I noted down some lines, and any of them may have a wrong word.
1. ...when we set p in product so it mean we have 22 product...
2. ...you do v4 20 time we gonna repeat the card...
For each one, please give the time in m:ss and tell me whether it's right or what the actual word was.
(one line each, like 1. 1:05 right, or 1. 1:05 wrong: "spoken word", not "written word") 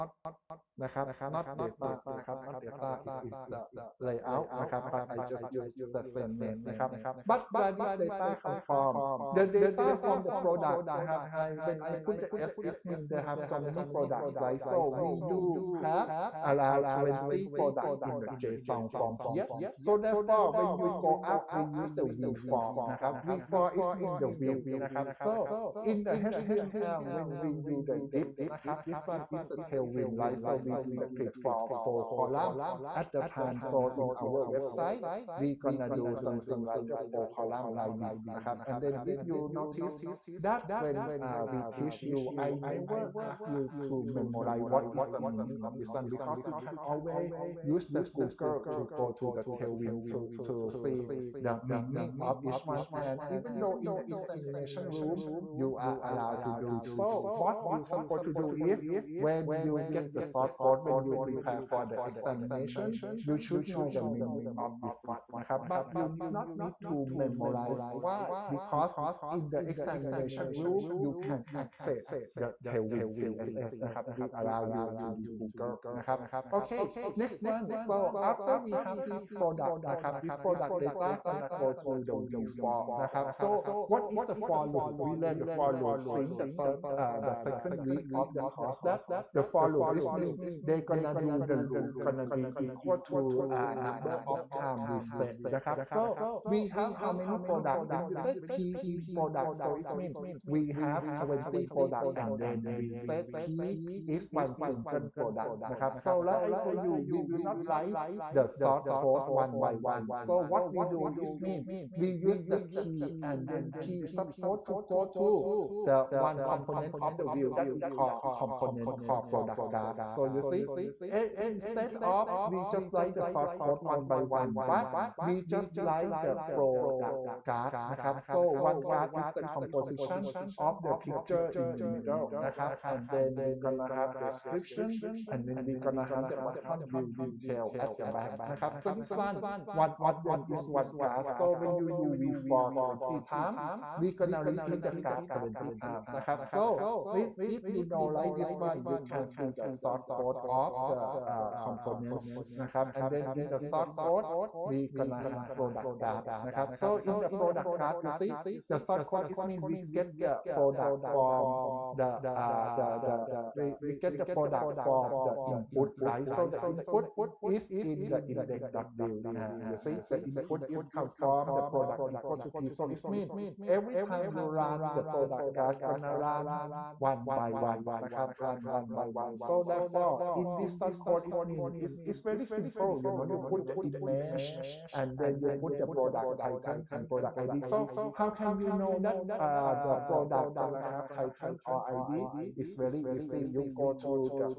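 1. 1:37 wrong: "20", not "22"
2. 2:21 right.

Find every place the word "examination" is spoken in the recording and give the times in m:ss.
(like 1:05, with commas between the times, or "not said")
0:54, 1:02, 1:09.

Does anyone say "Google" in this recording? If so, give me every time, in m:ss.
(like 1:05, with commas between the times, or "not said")
0:48, 1:15.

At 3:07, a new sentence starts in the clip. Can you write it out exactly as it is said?
So how can you know that uh, the product gonna have title or ID?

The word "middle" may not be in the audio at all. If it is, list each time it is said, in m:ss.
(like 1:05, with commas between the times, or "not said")
2:11.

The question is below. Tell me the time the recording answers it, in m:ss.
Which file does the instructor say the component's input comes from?
2:48.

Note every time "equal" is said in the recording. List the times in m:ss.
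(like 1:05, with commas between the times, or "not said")
1:32, 2:52.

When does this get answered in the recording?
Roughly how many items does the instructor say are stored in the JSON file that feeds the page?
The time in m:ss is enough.
0:16.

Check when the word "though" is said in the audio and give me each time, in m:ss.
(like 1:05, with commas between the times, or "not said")
0:53.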